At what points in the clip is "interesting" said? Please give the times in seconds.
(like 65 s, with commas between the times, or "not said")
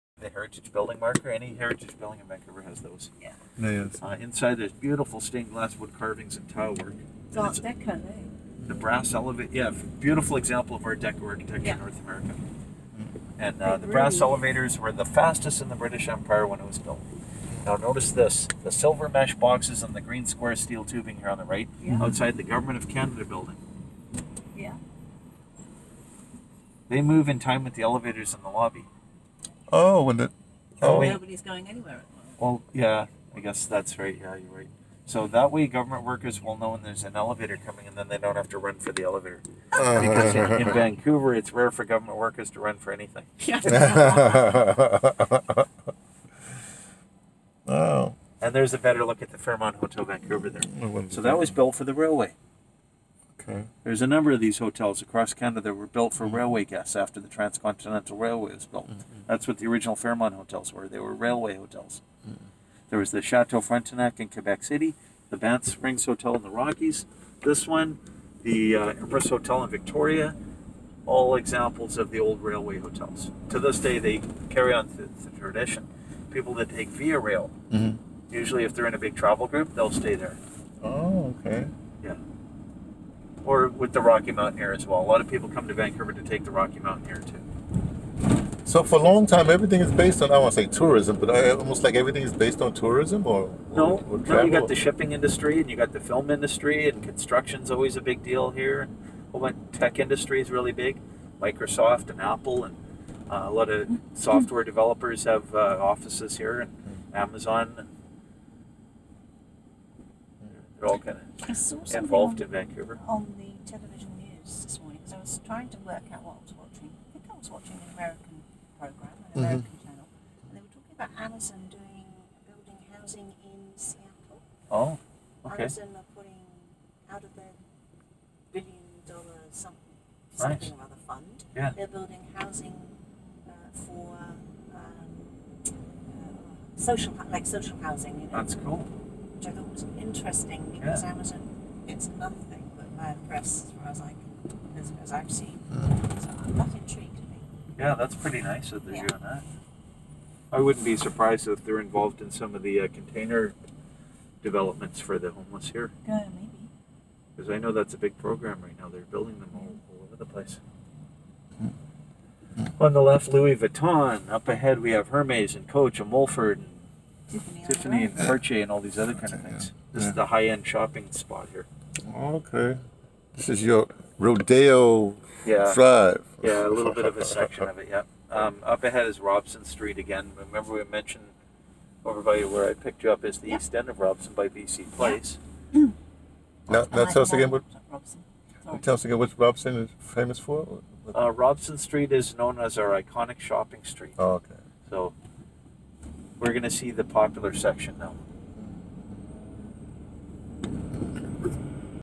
139 s.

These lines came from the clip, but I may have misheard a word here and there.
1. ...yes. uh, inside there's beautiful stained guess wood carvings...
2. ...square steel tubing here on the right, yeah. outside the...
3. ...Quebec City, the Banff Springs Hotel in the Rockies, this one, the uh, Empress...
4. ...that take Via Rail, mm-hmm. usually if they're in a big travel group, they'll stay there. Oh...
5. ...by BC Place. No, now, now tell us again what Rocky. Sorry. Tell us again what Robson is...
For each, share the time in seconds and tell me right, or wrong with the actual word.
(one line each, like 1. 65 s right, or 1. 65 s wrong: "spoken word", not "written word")
1. 3 s wrong: "glass", not "guess"
2. 20 s right
3. 64 s right
4. 76 s right
5. 184 s wrong: "Robson", not "Rocky".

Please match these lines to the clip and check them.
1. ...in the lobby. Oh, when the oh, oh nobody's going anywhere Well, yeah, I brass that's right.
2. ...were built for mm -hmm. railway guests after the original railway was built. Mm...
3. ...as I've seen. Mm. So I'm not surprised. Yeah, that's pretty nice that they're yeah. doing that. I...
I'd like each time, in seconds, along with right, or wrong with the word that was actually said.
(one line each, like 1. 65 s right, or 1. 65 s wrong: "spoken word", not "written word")
1. 28 s wrong: "guess", not "brass"
2. 55 s wrong: "transcontinental", not "original"
3. 145 s wrong: "intrigued", not "surprised".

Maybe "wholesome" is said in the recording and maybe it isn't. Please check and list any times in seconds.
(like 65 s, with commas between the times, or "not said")
not said.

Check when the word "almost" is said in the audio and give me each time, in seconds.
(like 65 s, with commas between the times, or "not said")
91 s.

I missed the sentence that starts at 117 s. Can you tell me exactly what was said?
I think I was watching an American program, an mm-hmm.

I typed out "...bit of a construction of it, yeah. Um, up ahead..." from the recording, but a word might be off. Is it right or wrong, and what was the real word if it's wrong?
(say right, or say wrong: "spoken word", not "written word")
wrong: "section", not "construction".